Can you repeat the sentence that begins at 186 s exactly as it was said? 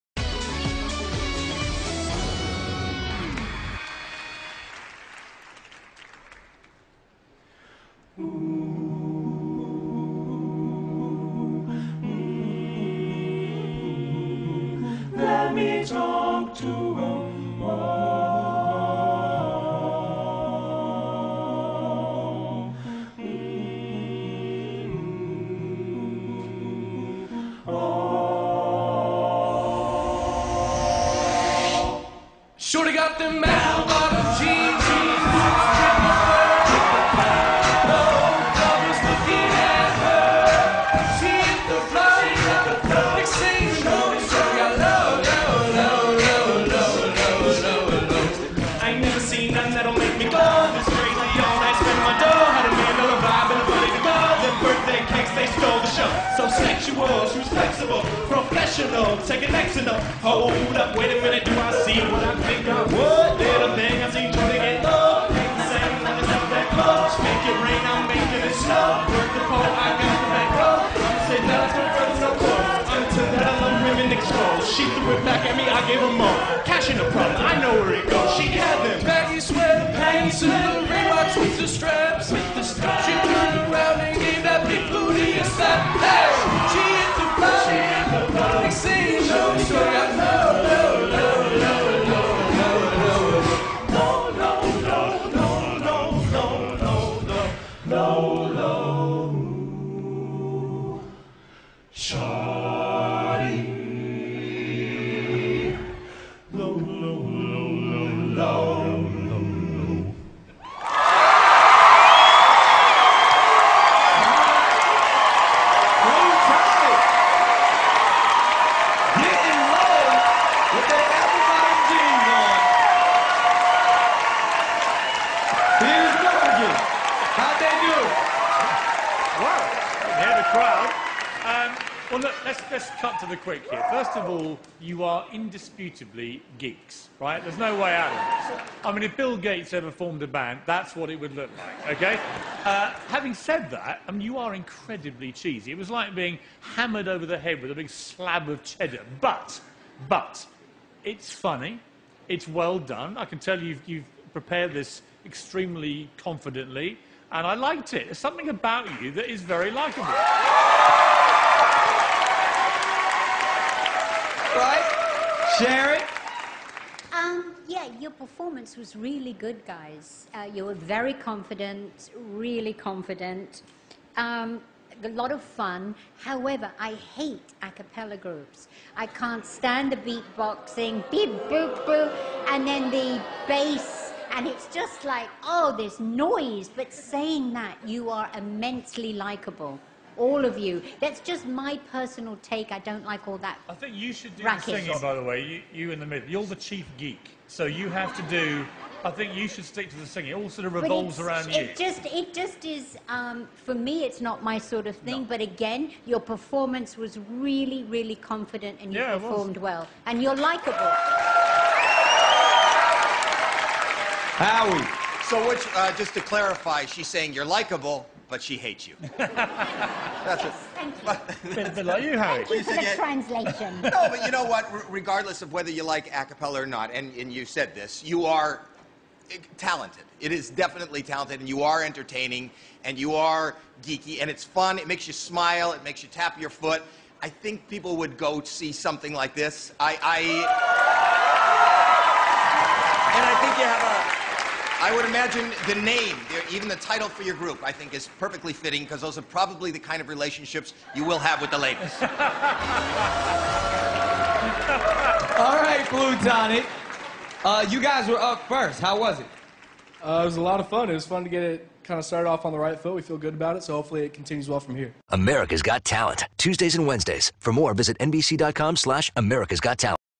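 But saying that, you are immensely likable all of you.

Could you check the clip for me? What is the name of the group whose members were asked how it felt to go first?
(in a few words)
Blue Tonic.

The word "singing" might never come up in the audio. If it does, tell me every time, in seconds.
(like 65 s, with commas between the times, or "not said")
194 s, 200 s.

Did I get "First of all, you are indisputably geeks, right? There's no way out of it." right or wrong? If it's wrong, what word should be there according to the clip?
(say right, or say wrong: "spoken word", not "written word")
right.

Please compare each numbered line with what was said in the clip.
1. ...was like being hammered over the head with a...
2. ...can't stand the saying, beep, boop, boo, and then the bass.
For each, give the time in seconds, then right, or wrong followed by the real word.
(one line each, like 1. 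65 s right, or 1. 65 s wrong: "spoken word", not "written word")
1. 145 s right
2. 179 s wrong: "beatboxing", not "saying".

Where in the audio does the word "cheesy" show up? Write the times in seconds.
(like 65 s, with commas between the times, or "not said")
145 s.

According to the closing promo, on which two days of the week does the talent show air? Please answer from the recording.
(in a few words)
Tuesdays and Wednesdays.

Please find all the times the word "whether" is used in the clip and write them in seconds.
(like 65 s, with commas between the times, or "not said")
225 s.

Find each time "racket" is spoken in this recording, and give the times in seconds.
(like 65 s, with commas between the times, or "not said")
194 s.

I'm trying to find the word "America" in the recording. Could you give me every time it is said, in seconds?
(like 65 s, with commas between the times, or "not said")
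265 s, 269 s.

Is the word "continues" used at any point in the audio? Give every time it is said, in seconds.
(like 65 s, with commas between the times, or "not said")
264 s.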